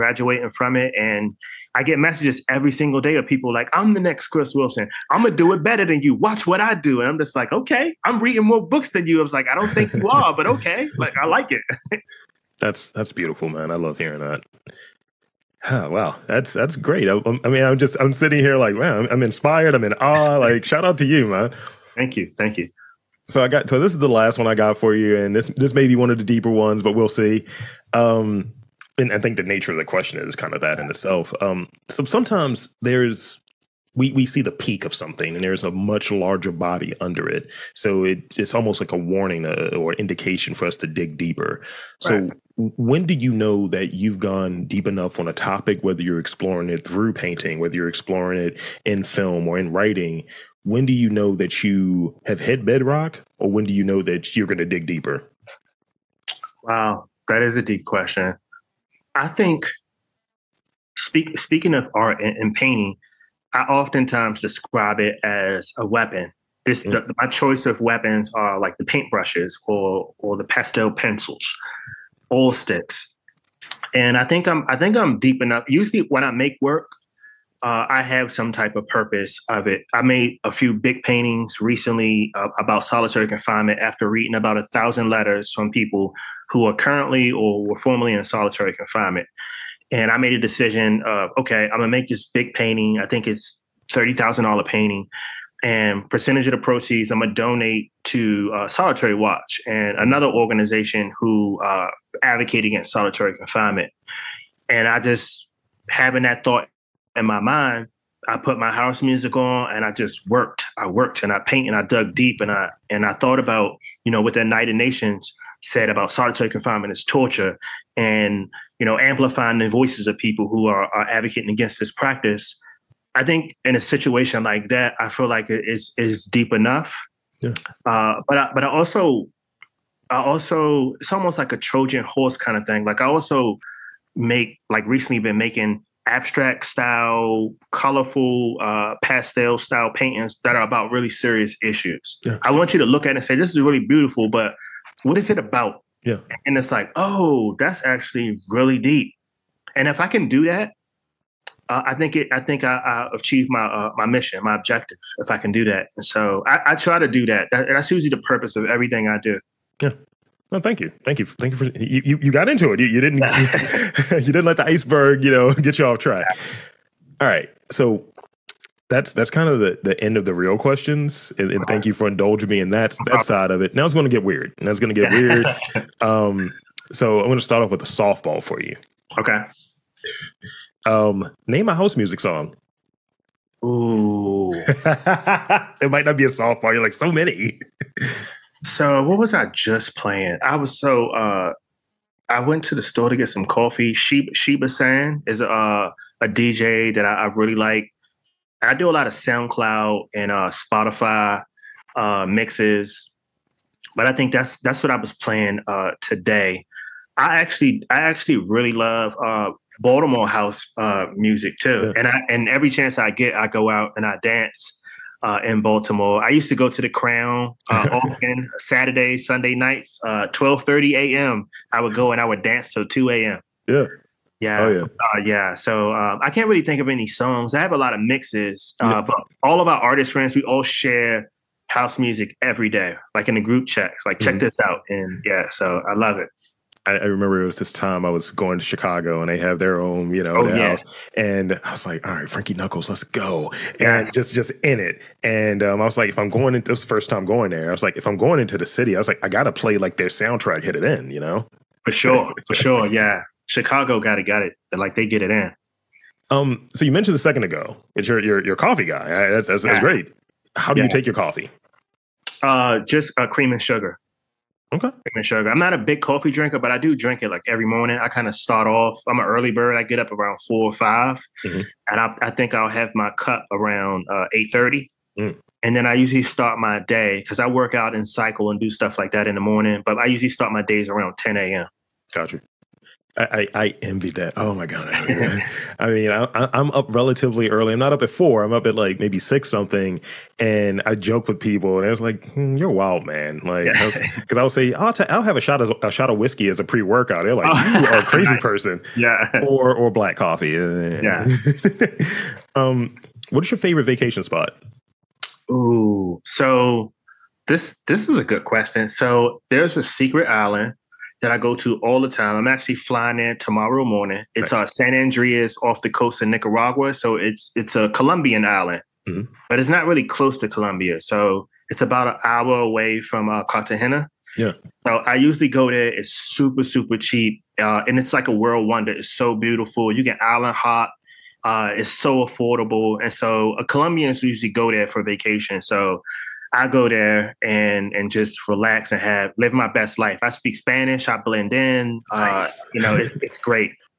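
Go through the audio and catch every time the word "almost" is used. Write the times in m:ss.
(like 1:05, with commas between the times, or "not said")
0:38, 2:11.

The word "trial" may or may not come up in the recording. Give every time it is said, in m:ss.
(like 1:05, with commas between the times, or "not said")
not said.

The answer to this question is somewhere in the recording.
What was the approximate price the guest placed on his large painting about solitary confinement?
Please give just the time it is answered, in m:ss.
1:33.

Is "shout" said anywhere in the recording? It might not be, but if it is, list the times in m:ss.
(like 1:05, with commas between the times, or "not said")
0:20.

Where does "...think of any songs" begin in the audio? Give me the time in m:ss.
3:46.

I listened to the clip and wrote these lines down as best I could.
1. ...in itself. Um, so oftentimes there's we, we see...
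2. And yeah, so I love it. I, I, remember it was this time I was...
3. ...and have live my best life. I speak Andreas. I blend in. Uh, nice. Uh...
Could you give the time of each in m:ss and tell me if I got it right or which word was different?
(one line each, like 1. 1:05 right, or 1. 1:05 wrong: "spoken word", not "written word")
1. 0:30 wrong: "sometimes", not "oftentimes"
2. 3:54 right
3. 5:38 wrong: "Spanish", not "Andreas".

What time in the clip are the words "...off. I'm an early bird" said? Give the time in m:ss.
4:28.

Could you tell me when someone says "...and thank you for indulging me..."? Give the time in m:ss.
2:51.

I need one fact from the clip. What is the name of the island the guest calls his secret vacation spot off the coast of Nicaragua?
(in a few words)
San Andreas.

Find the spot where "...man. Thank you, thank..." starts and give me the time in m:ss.
0:21.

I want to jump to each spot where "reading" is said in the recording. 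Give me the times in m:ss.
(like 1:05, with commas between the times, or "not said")
0:08, 1:24.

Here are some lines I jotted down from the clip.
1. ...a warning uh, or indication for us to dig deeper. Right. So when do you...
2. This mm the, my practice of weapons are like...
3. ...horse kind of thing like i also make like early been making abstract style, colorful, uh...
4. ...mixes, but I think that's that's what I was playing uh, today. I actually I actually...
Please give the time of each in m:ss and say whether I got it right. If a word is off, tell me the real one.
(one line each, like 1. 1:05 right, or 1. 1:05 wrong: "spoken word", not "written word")
1. 0:38 right
2. 1:06 wrong: "choice", not "practice"
3. 2:12 wrong: "recently", not "early"
4. 3:22 right.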